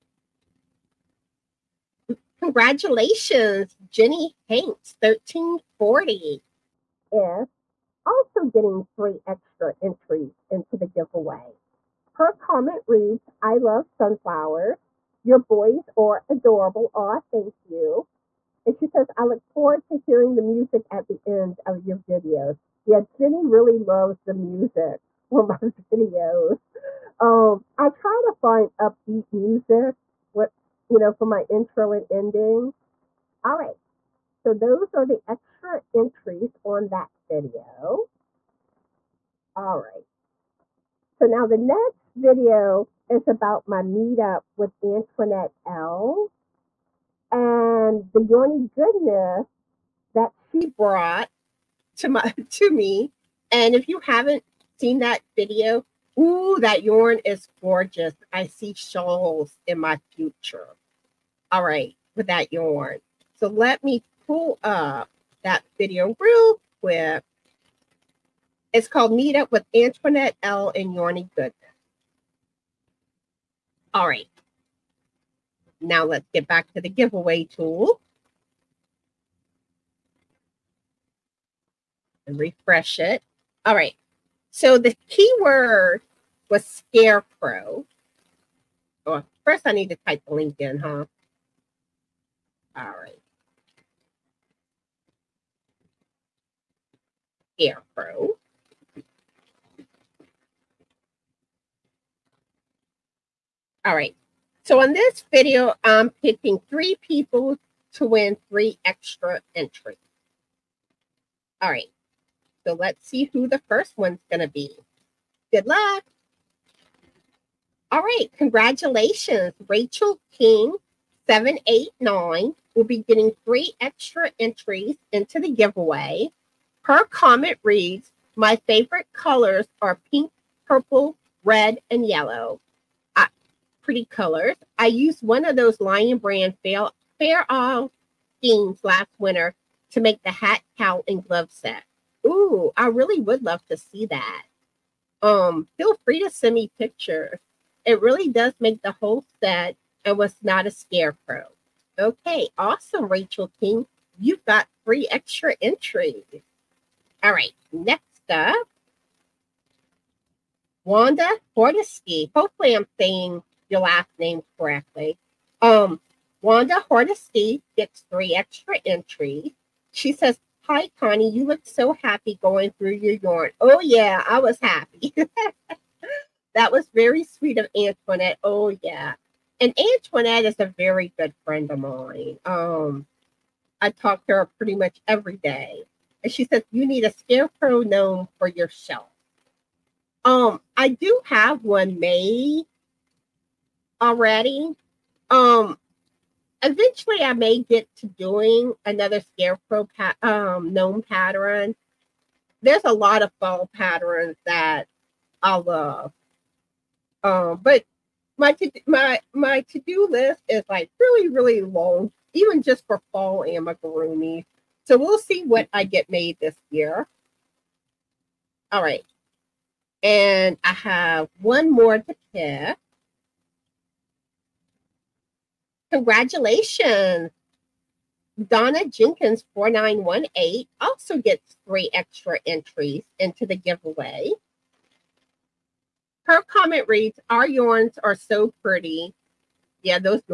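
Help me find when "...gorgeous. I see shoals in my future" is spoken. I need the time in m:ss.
0:57.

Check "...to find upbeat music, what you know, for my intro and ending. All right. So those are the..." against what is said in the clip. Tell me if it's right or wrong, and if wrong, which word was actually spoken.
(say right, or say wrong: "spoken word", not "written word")
right.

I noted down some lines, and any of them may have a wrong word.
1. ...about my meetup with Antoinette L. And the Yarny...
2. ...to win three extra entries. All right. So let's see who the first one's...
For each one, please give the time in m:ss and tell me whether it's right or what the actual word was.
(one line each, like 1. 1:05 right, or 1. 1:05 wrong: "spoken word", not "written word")
1. 0:43 right
2. 1:47 right.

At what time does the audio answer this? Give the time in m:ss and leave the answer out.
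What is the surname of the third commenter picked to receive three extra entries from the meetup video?
3:48.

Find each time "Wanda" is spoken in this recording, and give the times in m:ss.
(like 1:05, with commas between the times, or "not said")
2:40, 2:46.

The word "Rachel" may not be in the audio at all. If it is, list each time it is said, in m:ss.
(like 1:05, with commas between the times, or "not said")
1:59, 2:33.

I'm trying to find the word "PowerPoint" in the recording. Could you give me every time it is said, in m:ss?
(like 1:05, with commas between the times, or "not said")
not said.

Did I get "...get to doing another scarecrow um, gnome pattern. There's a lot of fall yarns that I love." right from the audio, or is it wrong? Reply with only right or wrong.
wrong.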